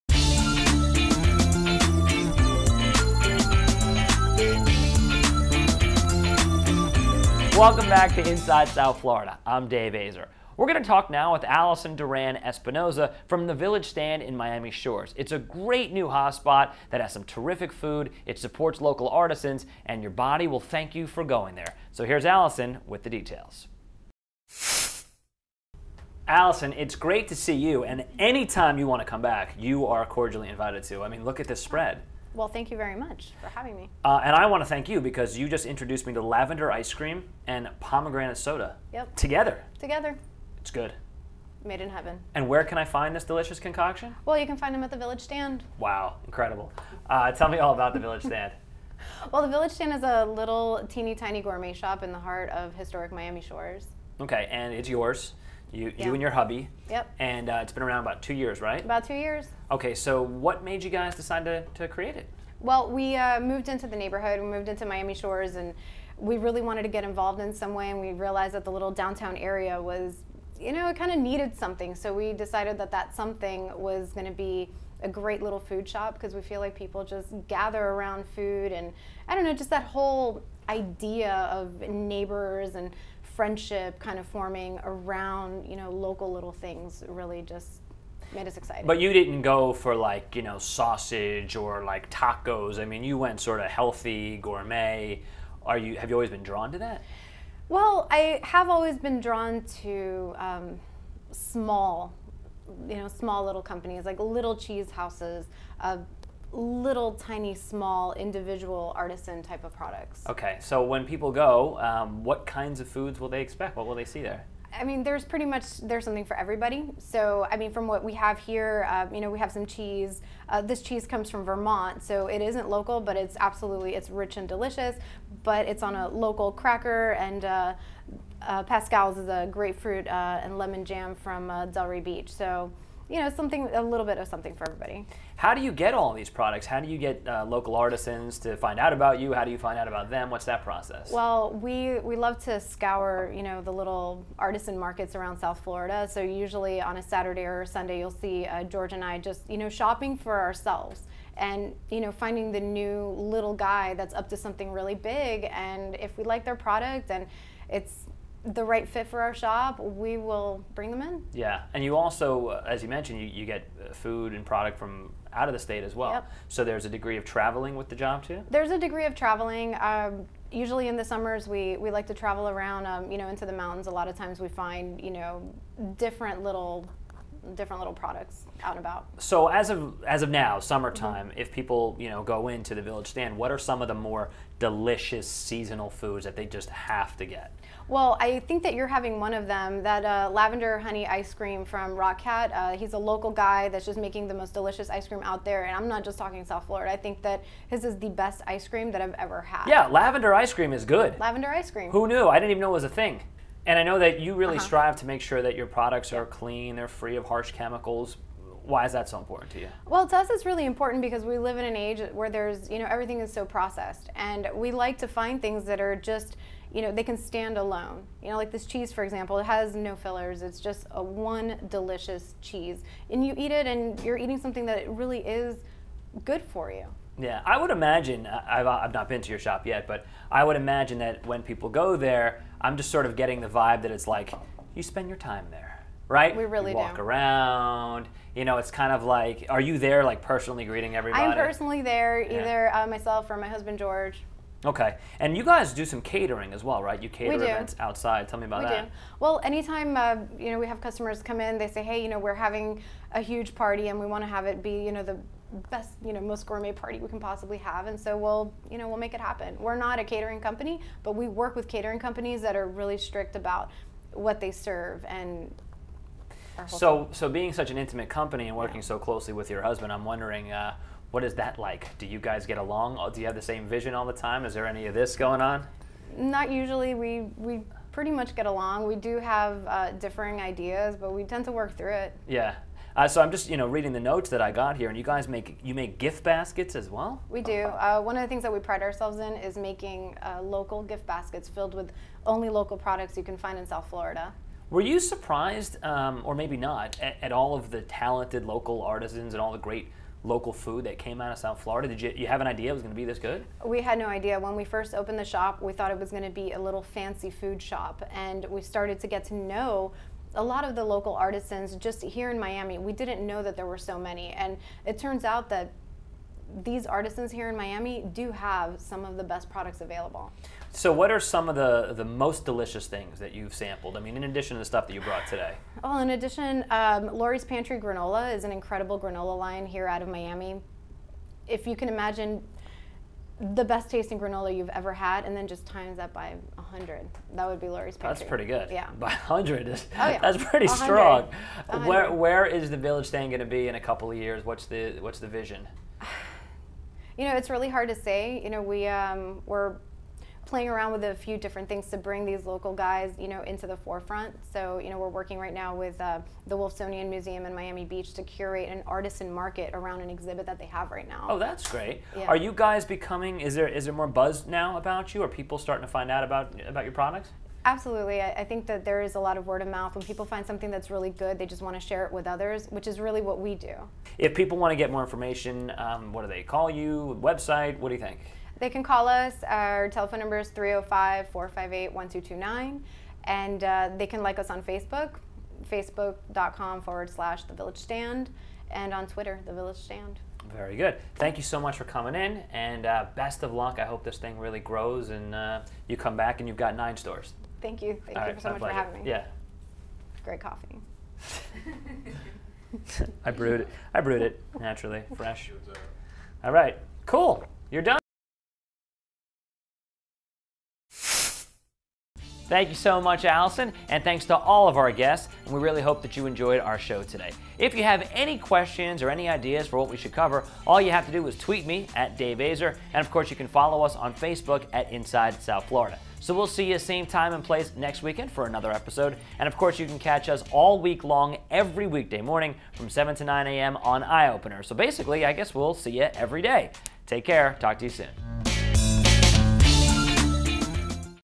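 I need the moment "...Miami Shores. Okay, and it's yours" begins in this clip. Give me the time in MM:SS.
00:53.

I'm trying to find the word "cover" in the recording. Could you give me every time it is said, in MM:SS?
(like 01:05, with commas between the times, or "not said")
07:00.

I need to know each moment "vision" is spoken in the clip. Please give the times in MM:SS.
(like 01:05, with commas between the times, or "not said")
04:33, 05:45.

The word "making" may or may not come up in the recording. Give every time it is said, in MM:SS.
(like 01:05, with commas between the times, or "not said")
03:13, 04:49.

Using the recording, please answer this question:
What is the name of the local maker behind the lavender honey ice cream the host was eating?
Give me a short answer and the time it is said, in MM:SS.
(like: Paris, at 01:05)
Rock Cat, at 03:11.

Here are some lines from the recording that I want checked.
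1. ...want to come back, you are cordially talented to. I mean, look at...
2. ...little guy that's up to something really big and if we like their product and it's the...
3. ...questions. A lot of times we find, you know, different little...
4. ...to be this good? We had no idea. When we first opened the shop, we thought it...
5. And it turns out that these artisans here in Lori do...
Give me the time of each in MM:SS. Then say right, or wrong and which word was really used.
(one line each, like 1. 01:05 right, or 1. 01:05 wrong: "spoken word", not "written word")
1. 00:28 wrong: "invited", not "talented"
2. 02:33 right
3. 02:53 wrong: "mountains", not "questions"
4. 05:02 right
5. 05:14 wrong: "Miami", not "Lori".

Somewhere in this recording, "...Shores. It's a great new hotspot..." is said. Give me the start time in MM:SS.
00:14.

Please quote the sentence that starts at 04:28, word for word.
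so closely with your husband, I'm wondering, uh, what is that like?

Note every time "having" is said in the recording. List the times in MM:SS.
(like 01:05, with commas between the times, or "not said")
00:33, 03:08, 04:12, 06:38.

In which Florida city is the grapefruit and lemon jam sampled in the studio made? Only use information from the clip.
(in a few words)
Delray Beach.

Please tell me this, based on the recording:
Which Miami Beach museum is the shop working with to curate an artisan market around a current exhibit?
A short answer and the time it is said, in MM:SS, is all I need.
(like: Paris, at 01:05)
Wolfsonian Museum, at 05:56.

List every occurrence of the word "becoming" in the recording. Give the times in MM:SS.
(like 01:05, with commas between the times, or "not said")
06:02.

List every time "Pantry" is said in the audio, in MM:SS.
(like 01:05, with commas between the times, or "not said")
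05:27, 05:37.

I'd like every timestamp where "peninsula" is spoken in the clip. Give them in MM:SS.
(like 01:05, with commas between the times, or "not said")
not said.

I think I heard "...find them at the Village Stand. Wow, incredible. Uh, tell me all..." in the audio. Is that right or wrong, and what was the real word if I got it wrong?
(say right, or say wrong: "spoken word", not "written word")
right.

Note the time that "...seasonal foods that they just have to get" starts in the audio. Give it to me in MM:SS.
03:05.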